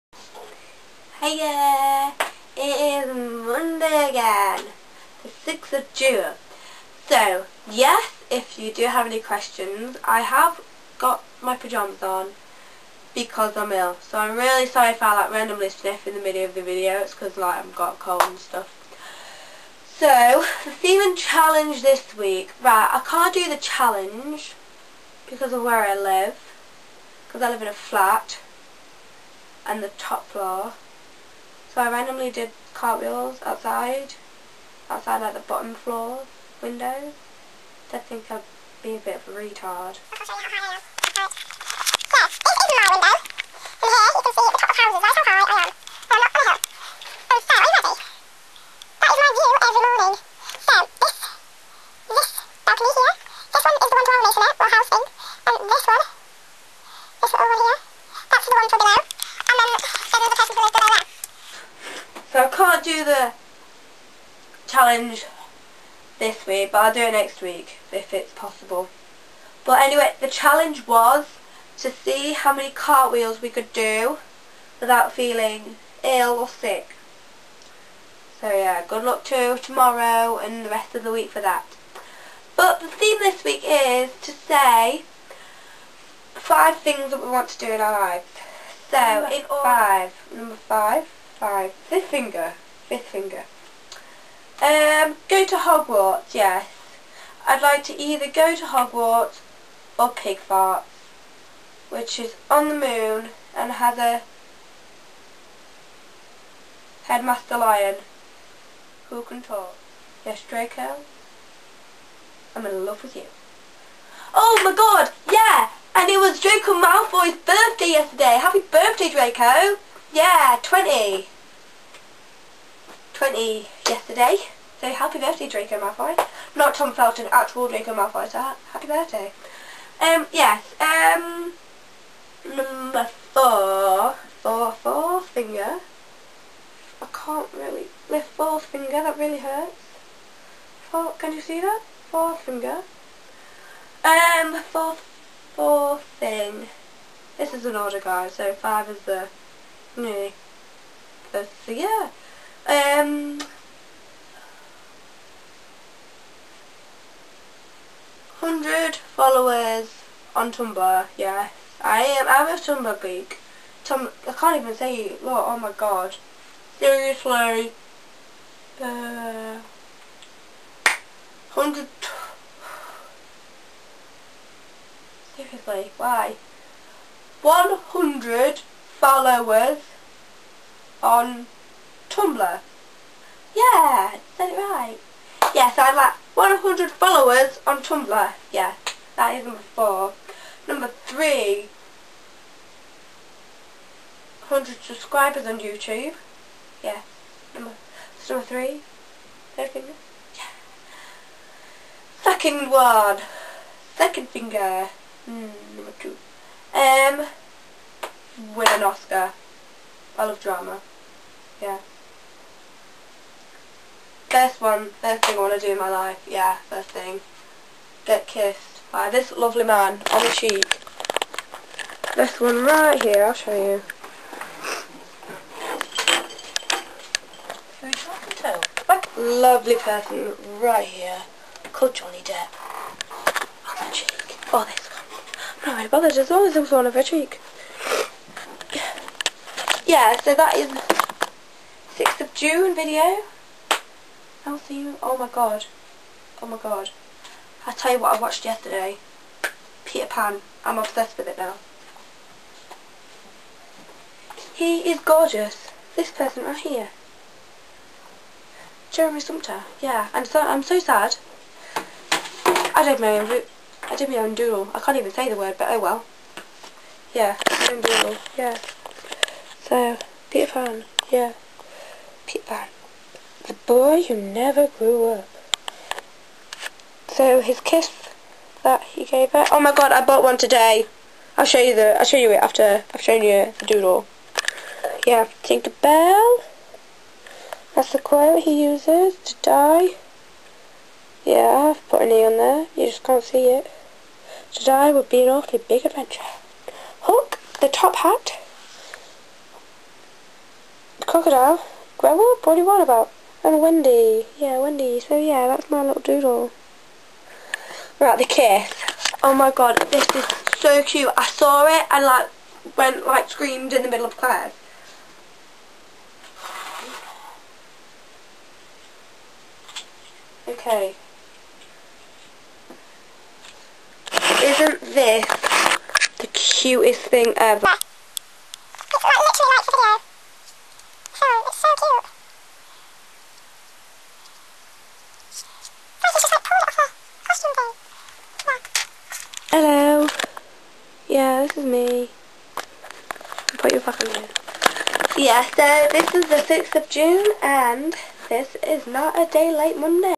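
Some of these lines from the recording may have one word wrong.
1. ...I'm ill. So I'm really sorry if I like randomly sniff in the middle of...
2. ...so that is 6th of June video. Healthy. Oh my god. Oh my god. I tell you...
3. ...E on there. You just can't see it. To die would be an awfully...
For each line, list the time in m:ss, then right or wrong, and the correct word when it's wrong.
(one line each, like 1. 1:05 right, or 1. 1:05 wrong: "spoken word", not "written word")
1. 0:13 right
2. 4:00 right
3. 4:52 right.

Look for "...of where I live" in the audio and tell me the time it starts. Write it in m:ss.
0:25.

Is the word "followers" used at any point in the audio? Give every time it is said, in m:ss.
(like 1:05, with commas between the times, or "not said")
2:38, 2:58, 3:06.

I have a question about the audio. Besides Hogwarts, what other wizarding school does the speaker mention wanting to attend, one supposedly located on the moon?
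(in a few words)
Pig Farts.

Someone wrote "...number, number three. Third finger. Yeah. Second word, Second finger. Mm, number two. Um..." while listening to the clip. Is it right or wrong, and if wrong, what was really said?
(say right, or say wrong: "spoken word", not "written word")
right.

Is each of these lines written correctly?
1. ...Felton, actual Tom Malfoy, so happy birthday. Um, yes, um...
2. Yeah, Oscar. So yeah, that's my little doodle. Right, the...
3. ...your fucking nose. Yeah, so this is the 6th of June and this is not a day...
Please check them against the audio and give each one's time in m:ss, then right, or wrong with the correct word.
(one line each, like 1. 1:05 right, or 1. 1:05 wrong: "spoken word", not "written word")
1. 2:06 wrong: "Draco", not "Tom"
2. 5:04 wrong: "Wendy", not "Oscar"
3. 5:43 right.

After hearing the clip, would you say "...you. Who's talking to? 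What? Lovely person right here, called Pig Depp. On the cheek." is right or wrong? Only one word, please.
wrong.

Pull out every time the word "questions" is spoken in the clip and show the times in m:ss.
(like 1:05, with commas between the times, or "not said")
0:09.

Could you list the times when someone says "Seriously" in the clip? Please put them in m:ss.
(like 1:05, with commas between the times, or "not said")
2:46, 2:55.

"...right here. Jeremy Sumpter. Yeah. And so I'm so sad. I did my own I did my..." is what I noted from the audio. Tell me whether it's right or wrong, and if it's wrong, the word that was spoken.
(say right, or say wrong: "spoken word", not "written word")
right.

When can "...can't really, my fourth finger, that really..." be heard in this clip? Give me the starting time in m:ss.
2:17.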